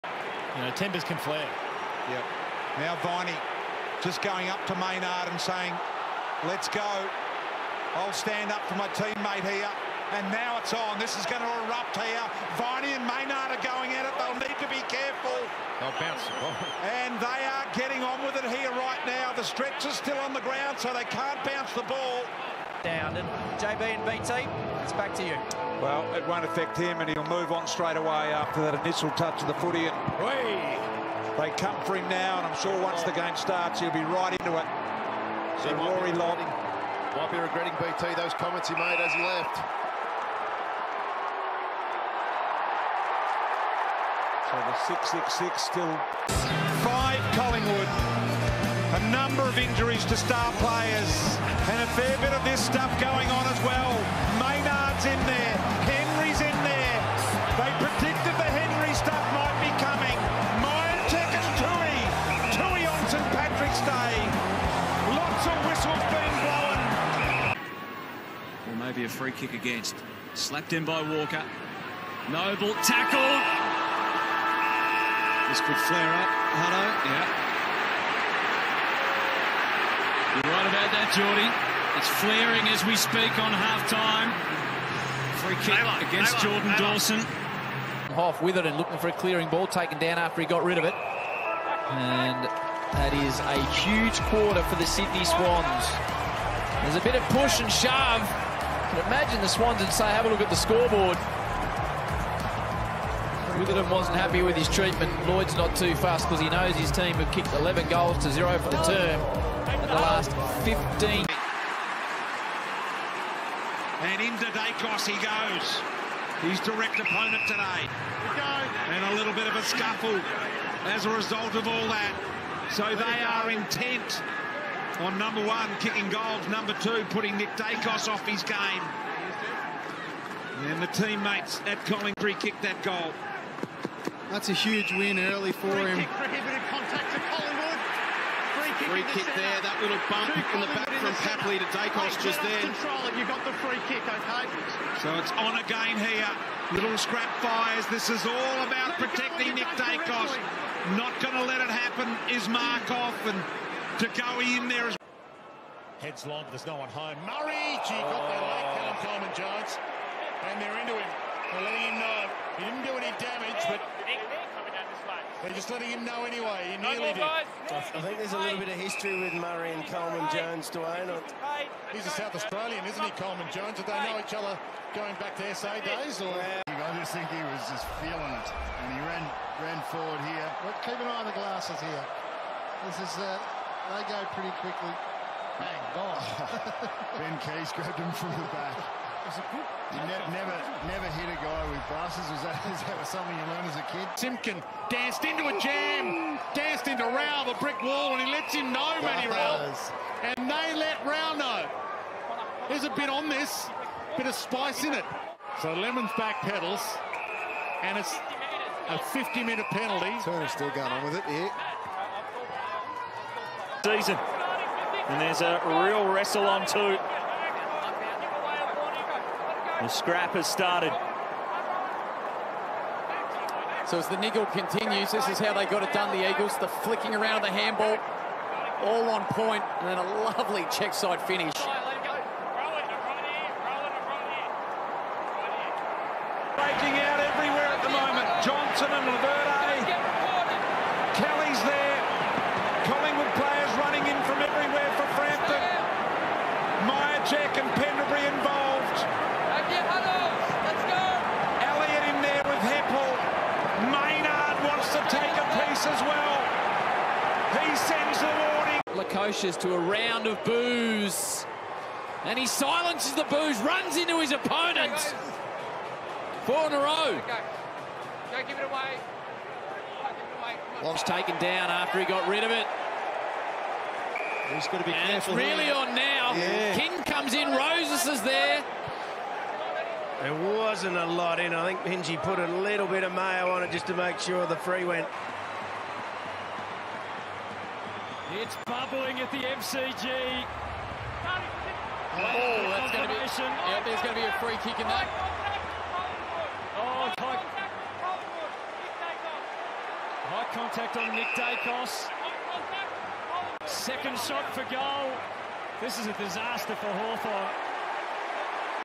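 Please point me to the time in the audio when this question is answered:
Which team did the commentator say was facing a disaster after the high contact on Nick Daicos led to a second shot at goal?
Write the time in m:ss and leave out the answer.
5:06.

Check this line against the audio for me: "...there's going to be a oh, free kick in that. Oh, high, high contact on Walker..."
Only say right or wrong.
wrong.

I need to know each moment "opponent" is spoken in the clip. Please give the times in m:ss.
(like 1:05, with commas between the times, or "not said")
1:56, 4:24.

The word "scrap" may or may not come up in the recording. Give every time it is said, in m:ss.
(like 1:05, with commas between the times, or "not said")
2:26, 3:39.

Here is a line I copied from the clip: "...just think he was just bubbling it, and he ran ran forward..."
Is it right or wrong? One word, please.
wrong.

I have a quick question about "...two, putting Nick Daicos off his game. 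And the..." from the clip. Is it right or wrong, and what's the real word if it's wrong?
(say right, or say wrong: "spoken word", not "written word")
right.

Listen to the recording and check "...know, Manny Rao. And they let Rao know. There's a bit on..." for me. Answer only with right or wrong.
right.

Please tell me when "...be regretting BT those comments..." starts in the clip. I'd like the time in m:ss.
0:37.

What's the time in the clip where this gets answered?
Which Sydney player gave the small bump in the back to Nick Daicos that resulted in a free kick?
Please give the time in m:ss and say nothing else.
2:21.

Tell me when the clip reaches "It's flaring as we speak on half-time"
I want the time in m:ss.
1:21.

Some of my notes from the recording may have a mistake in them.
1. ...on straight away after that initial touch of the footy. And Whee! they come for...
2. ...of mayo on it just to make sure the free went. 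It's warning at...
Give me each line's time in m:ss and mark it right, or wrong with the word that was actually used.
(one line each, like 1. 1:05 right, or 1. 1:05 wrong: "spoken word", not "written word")
1. 0:27 right
2. 4:43 wrong: "bubbling", not "warning".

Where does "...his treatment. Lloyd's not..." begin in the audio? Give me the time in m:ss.
1:44.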